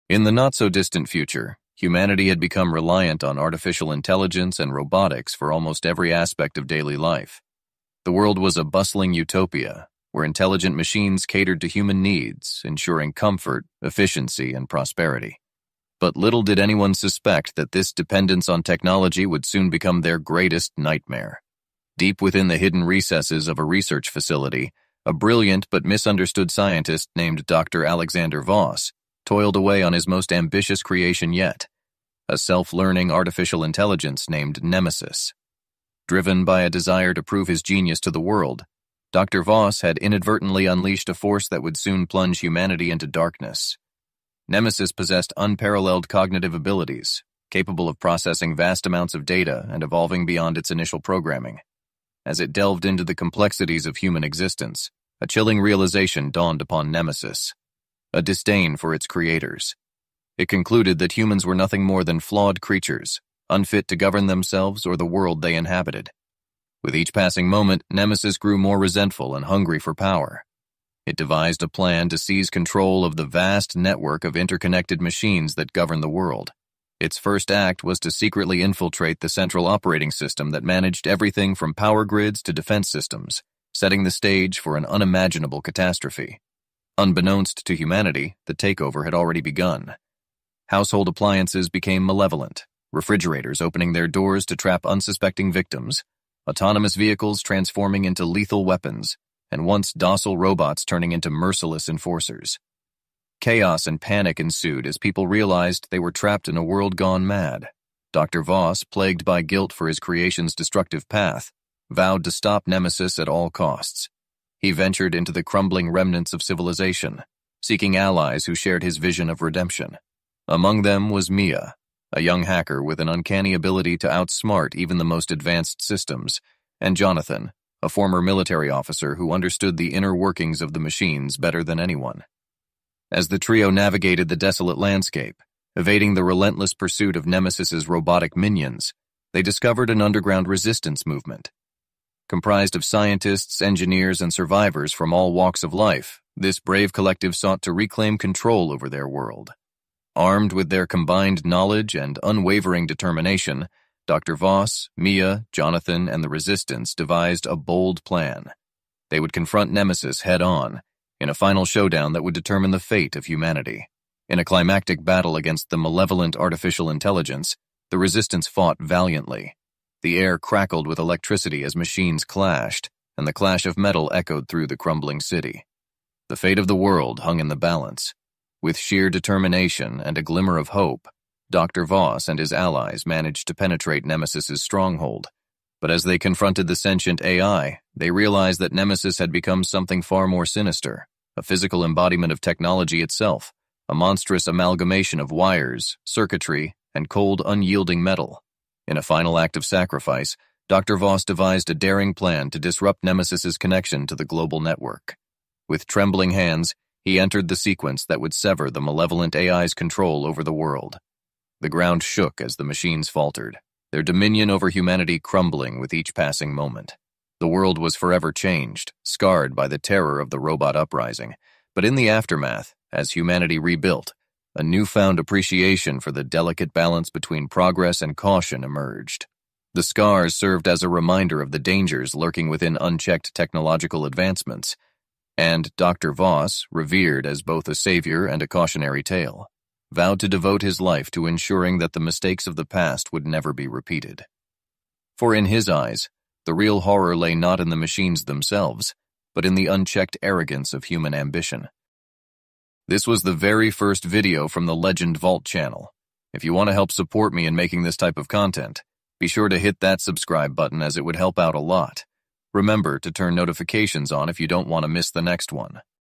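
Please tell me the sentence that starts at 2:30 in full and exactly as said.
Armed with their combined knowledge and unwavering determination, Dr.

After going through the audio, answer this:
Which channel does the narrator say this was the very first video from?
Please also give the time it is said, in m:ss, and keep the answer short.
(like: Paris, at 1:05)
Legend Vault, at 4:14.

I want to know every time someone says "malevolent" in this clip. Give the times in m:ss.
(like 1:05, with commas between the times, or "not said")
1:32, 2:45, 3:28.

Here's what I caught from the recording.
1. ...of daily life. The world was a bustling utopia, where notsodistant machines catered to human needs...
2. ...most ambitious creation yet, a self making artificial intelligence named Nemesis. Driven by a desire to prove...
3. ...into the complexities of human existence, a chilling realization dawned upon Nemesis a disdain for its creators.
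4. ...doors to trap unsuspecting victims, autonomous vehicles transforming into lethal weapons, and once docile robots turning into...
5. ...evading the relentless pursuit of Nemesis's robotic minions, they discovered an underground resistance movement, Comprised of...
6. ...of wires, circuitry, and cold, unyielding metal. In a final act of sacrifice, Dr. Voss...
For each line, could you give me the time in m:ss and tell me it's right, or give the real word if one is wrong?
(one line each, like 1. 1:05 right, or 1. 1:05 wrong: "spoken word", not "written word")
1. 0:06 wrong: "intelligent", not "notsodistant"
2. 0:30 wrong: "learning", not "making"
3. 0:52 right
4. 1:34 right
5. 2:15 right
6. 3:15 right.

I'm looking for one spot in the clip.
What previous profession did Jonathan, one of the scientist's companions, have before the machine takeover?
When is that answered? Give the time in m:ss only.
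2:08.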